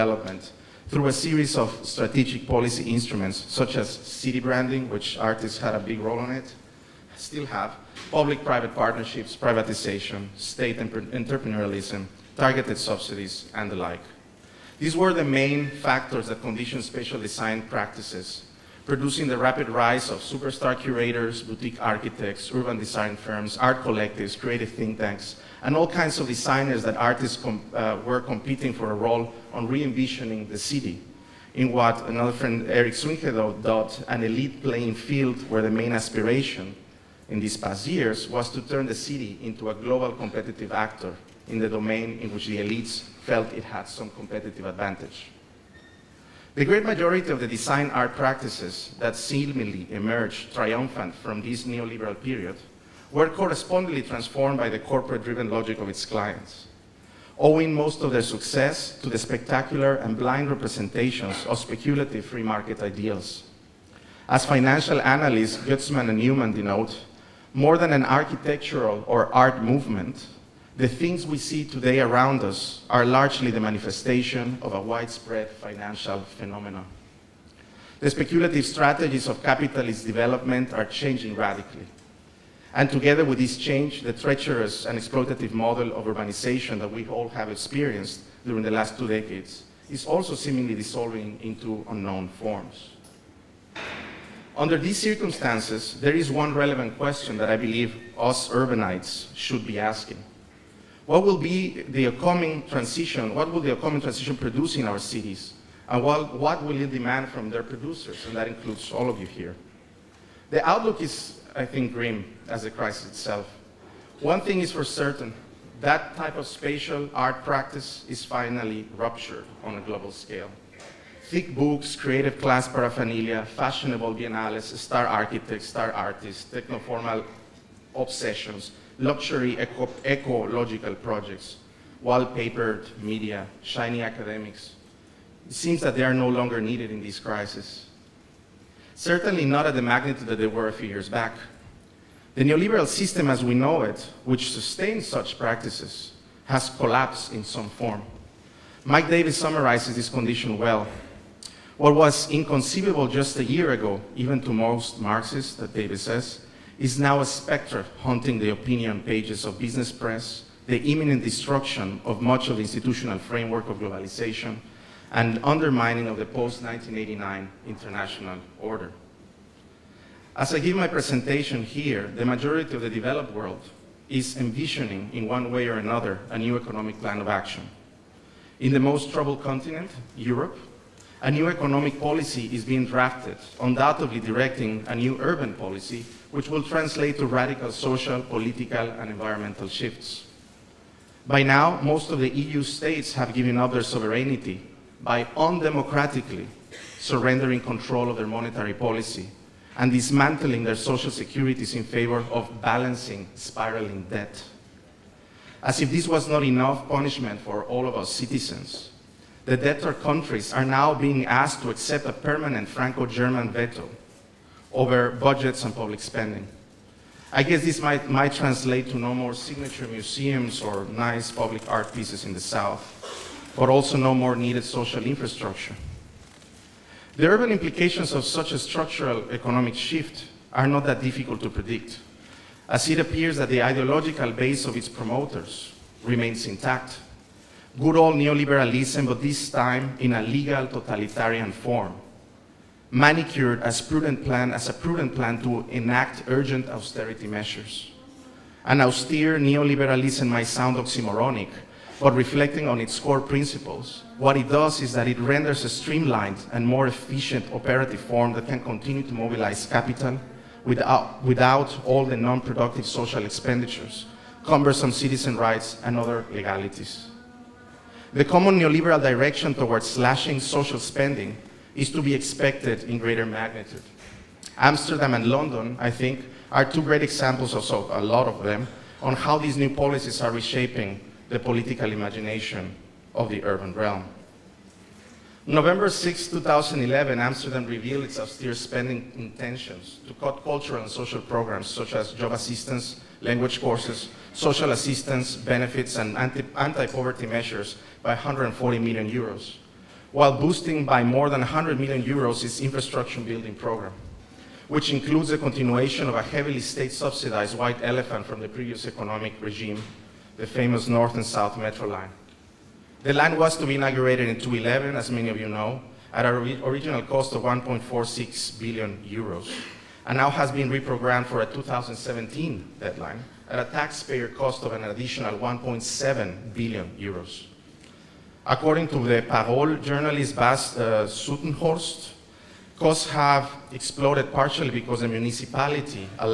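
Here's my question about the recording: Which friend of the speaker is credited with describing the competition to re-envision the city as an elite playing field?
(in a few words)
Eric Swyngedouw.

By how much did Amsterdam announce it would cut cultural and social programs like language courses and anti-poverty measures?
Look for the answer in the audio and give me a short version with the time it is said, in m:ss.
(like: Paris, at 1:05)
140 million euros, at 4:58.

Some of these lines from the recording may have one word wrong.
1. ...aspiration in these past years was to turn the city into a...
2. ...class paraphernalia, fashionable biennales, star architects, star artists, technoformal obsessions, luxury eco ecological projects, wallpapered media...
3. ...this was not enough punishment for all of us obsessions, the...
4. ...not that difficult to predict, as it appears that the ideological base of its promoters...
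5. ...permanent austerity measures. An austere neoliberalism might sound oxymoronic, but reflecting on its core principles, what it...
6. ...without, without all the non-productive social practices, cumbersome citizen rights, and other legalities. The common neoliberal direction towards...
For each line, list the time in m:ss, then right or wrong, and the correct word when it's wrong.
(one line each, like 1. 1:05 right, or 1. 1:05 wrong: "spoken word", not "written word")
1. 0:35 right
2. 2:02 right
3. 3:25 wrong: "citizens", not "obsessions"
4. 3:50 right
5. 4:06 wrong: "urgent", not "permanent"
6. 4:20 wrong: "expenditures", not "practices".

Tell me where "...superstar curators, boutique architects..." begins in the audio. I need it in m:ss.
0:20.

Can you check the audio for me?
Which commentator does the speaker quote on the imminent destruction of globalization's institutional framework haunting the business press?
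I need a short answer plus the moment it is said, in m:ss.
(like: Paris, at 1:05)
Mike Davis, at 2:28.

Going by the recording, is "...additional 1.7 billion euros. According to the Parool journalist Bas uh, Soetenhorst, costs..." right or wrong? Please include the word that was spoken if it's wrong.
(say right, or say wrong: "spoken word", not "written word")
right.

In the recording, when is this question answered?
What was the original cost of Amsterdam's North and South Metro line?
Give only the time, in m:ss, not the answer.
5:17.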